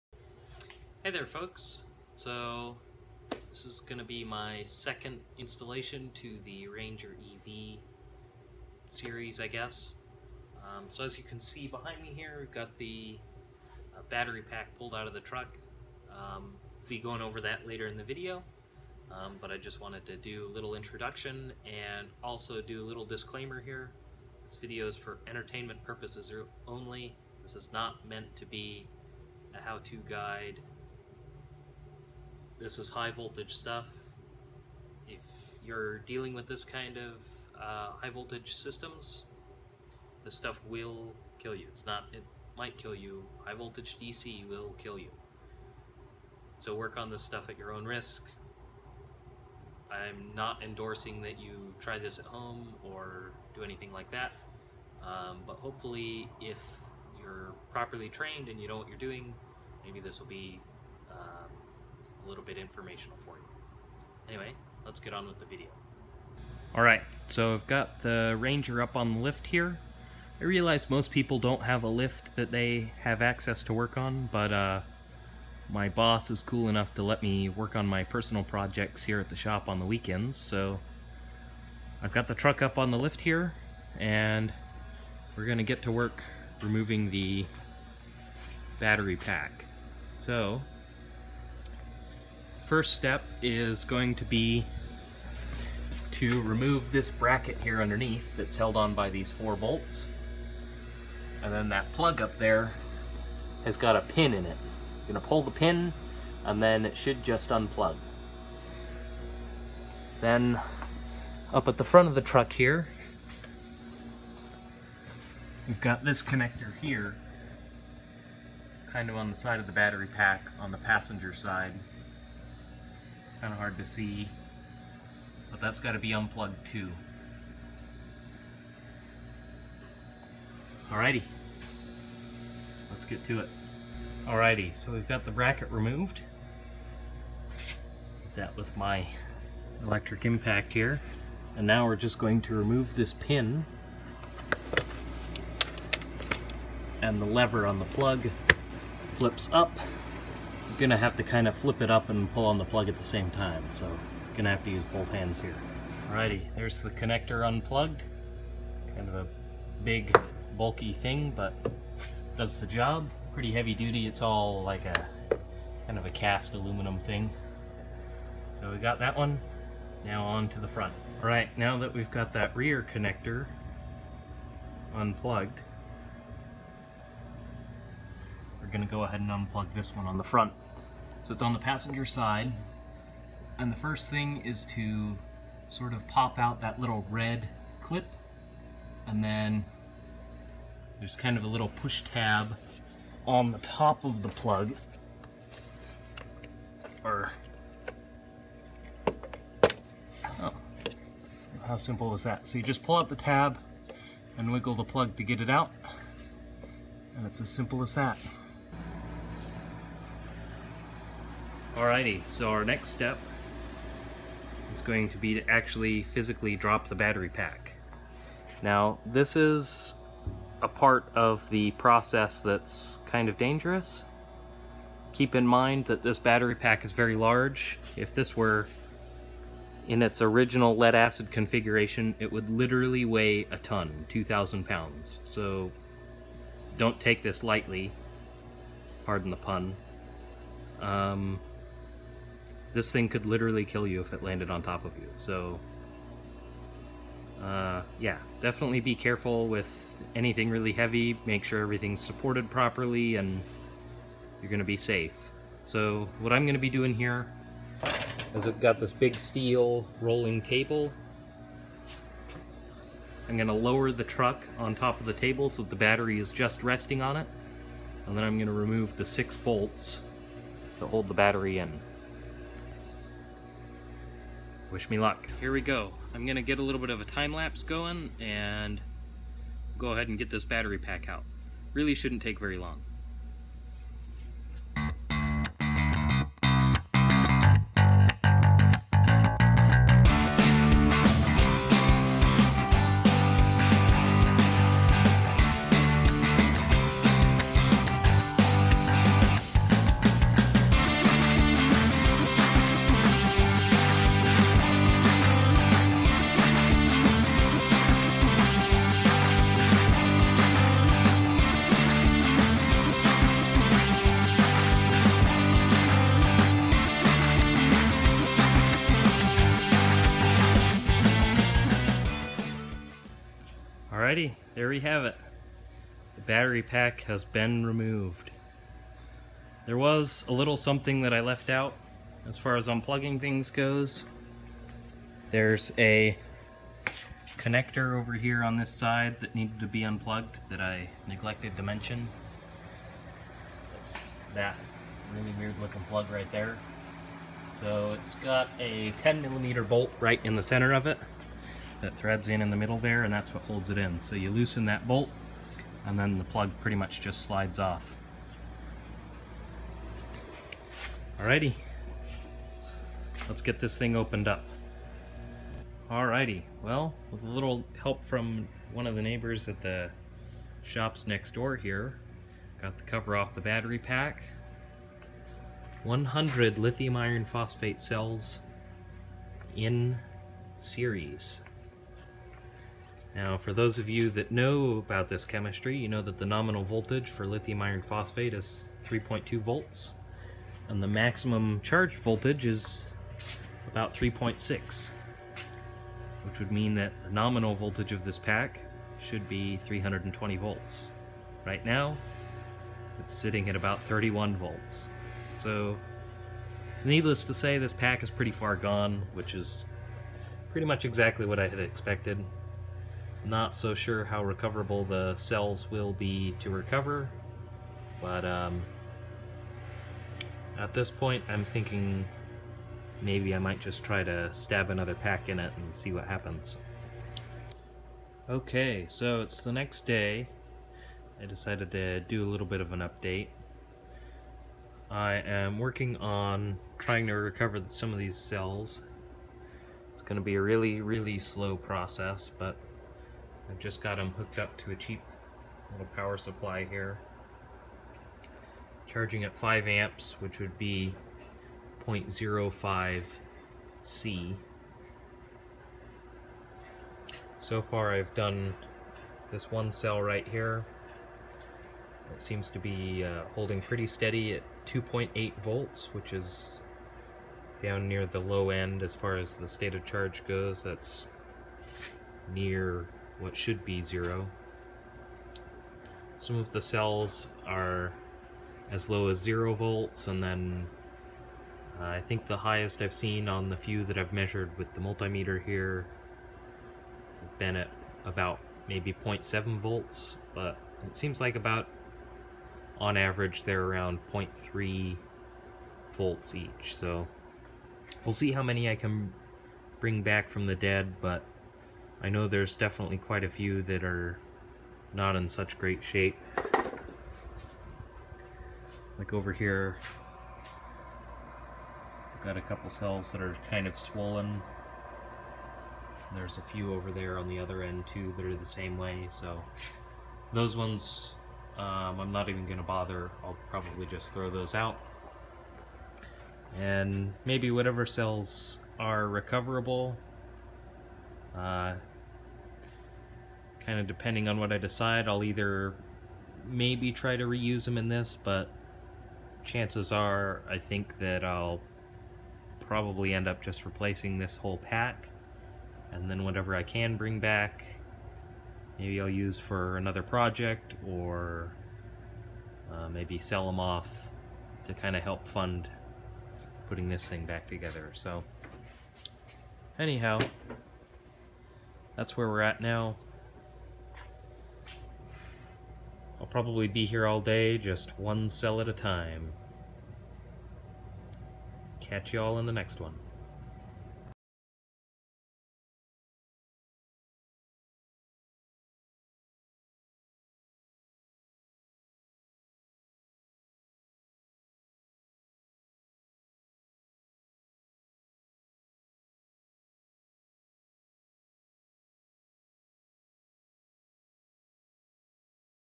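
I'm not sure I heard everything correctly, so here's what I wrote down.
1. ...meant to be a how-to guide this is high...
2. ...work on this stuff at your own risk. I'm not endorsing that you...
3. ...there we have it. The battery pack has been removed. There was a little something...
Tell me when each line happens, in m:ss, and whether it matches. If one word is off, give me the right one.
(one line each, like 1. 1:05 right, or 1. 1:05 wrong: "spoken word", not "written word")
1. 0:28 right
2. 0:46 right
3. 5:24 right.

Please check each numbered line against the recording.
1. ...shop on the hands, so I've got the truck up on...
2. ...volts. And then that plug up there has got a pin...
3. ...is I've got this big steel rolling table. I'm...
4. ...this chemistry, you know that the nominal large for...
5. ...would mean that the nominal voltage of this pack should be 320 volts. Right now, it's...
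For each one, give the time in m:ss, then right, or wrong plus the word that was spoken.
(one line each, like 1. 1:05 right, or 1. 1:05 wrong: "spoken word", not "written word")
1. 1:19 wrong: "weekends", not "hands"
2. 1:39 wrong: "bolts", not "volts"
3. 4:18 right
4. 6:25 wrong: "voltage", not "large"
5. 6:36 right.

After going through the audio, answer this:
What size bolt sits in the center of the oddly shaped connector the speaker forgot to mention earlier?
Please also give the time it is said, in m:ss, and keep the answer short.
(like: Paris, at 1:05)
10 millimeter, at 5:48.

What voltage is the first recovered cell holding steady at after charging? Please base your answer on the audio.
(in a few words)
2.8 volts.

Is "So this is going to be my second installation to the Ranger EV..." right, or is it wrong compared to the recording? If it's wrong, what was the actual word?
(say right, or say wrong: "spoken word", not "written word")
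right.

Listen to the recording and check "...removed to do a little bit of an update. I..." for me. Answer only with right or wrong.
wrong.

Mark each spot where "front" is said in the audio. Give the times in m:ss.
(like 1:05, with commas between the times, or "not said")
1:51, 2:50, 3:00.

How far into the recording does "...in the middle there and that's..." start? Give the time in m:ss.
5:52.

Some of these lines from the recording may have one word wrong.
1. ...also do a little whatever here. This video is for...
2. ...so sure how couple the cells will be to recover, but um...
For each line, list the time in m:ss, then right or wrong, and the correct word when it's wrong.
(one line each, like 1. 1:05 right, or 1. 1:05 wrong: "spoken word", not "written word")
1. 0:22 wrong: "disclaimer", not "whatever"
2. 6:53 wrong: "recoverable", not "couple".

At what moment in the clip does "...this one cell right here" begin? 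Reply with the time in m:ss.
7:39.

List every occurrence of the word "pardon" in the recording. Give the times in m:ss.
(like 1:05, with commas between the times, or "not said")
3:59.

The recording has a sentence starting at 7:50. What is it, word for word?
That's near what should be zero.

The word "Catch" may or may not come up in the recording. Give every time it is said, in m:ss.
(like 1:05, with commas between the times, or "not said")
9:31.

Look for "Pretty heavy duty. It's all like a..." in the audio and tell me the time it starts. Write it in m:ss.
2:43.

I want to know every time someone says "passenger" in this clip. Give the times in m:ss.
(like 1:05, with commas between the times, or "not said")
2:00, 3:01.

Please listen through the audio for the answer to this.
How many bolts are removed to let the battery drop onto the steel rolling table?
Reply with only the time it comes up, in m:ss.
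4:29.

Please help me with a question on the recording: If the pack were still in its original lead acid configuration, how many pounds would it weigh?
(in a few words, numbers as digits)
2,000 pounds.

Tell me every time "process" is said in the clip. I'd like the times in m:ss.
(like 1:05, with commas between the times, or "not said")
3:41, 7:21.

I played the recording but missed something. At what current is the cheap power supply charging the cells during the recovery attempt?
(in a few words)
5 amps.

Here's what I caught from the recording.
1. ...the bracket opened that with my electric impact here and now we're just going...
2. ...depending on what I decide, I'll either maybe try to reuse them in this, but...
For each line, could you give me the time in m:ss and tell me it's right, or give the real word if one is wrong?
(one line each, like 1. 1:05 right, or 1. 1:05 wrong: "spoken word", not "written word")
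1. 2:15 wrong: "removed", not "opened"
2. 8:53 right.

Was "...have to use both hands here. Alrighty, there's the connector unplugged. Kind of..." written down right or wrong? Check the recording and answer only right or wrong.
right.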